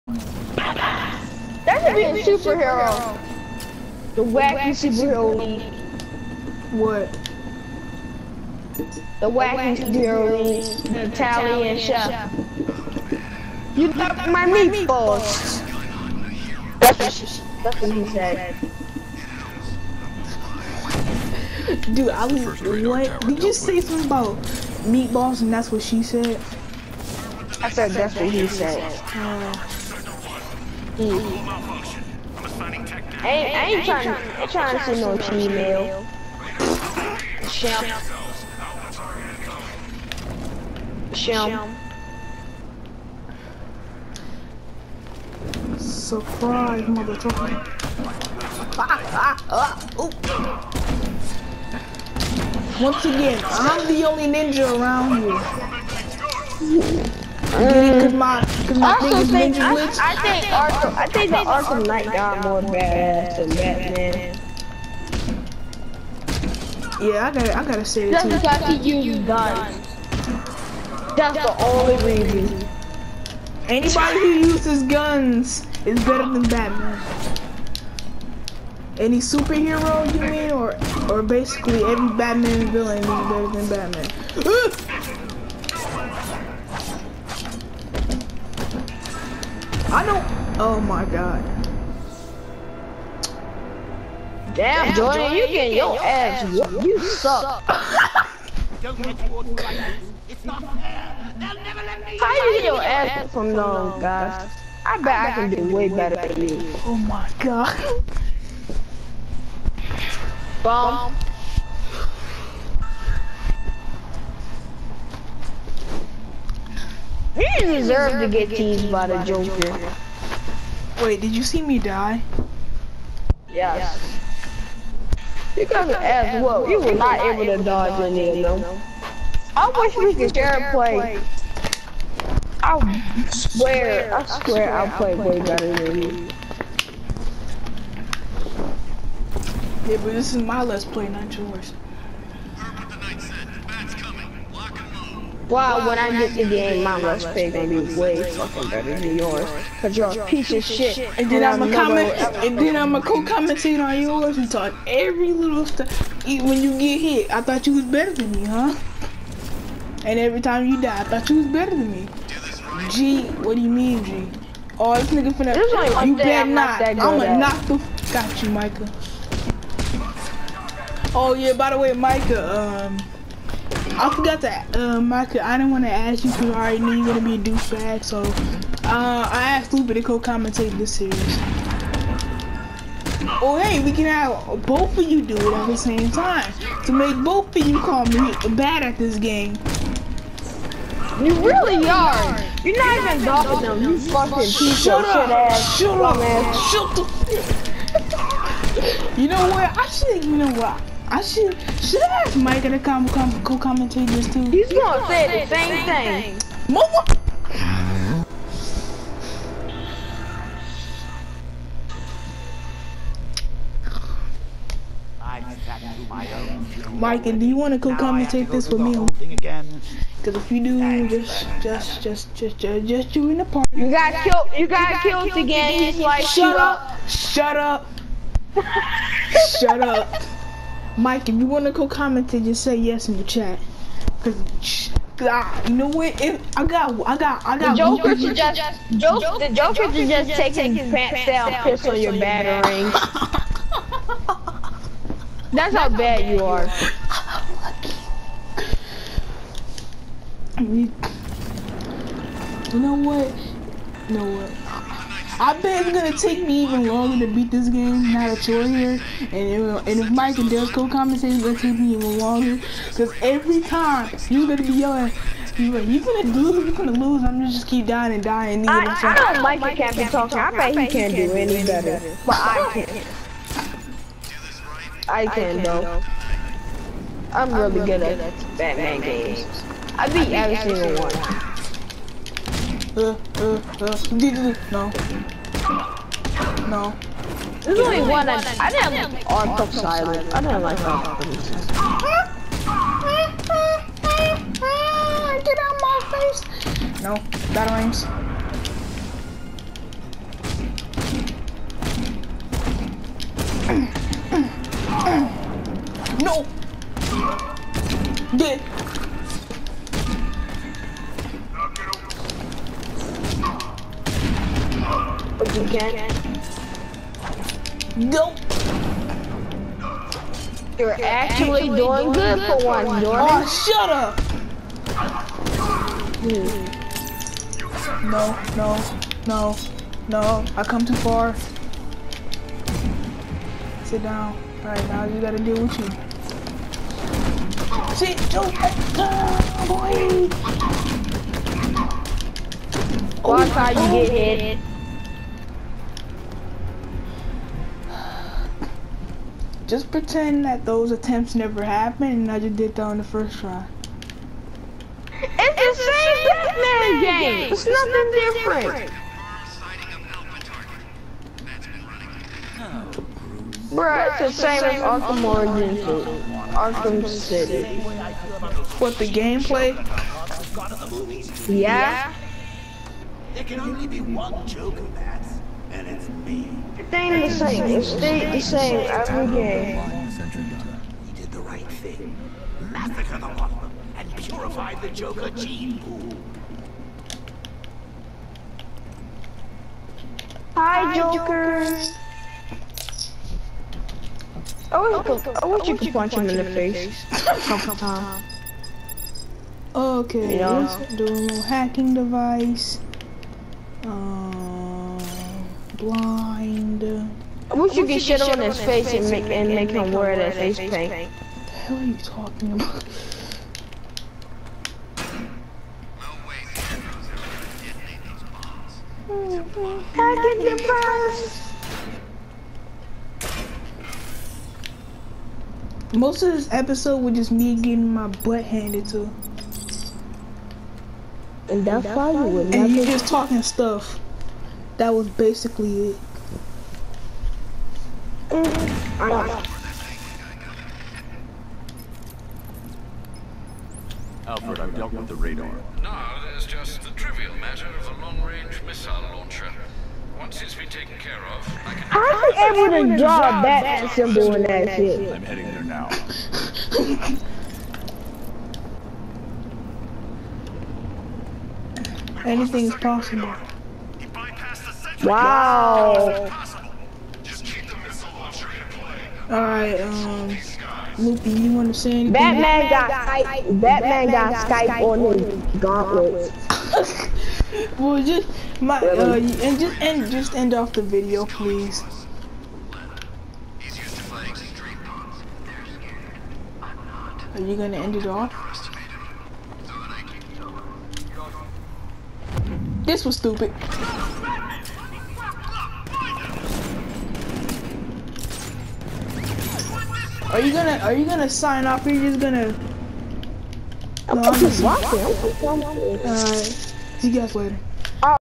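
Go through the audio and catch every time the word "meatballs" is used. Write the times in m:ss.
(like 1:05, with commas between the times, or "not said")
0:14, 0:24.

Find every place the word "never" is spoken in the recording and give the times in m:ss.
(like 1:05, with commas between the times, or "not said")
1:41, 5:51.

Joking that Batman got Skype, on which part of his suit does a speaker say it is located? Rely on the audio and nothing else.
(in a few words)
gauntlets.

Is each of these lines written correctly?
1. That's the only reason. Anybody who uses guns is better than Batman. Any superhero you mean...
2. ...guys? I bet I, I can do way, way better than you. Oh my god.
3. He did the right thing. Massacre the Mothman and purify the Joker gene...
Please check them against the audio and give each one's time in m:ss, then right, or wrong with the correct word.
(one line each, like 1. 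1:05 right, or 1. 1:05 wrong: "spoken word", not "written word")
1. 1:11 right
2. 1:44 right
3. 6:21 right.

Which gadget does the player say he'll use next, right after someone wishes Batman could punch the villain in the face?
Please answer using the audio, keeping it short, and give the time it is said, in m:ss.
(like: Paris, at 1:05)
hacking device, at 6:41.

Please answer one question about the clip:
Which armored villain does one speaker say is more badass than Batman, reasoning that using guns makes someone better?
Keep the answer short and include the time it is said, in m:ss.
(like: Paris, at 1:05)
Arkham Knight, at 1:01.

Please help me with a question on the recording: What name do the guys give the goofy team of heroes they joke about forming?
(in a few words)
wacky superhero league.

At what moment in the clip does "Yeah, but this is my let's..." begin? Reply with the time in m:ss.
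2:19.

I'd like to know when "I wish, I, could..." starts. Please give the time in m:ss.
6:34.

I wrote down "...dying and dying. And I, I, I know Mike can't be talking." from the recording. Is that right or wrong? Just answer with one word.
right.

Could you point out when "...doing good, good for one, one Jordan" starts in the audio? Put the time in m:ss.
5:21.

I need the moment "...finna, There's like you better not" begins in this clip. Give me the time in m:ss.
2:45.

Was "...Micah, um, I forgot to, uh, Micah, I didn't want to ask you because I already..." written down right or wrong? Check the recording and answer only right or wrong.
right.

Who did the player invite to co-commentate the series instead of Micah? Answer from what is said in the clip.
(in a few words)
Lupa.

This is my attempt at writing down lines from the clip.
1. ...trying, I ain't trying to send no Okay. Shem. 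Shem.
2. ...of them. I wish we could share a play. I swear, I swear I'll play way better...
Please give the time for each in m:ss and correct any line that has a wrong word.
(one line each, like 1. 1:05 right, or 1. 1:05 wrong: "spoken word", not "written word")
1. 0:33 wrong: "Gmail", not "Okay"
2. 2:08 right.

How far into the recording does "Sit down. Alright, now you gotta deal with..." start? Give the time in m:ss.
5:33.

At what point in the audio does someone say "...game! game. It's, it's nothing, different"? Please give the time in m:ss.
5:57.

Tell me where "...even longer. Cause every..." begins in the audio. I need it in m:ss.
4:21.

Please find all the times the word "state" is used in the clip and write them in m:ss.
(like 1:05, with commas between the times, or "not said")
not said.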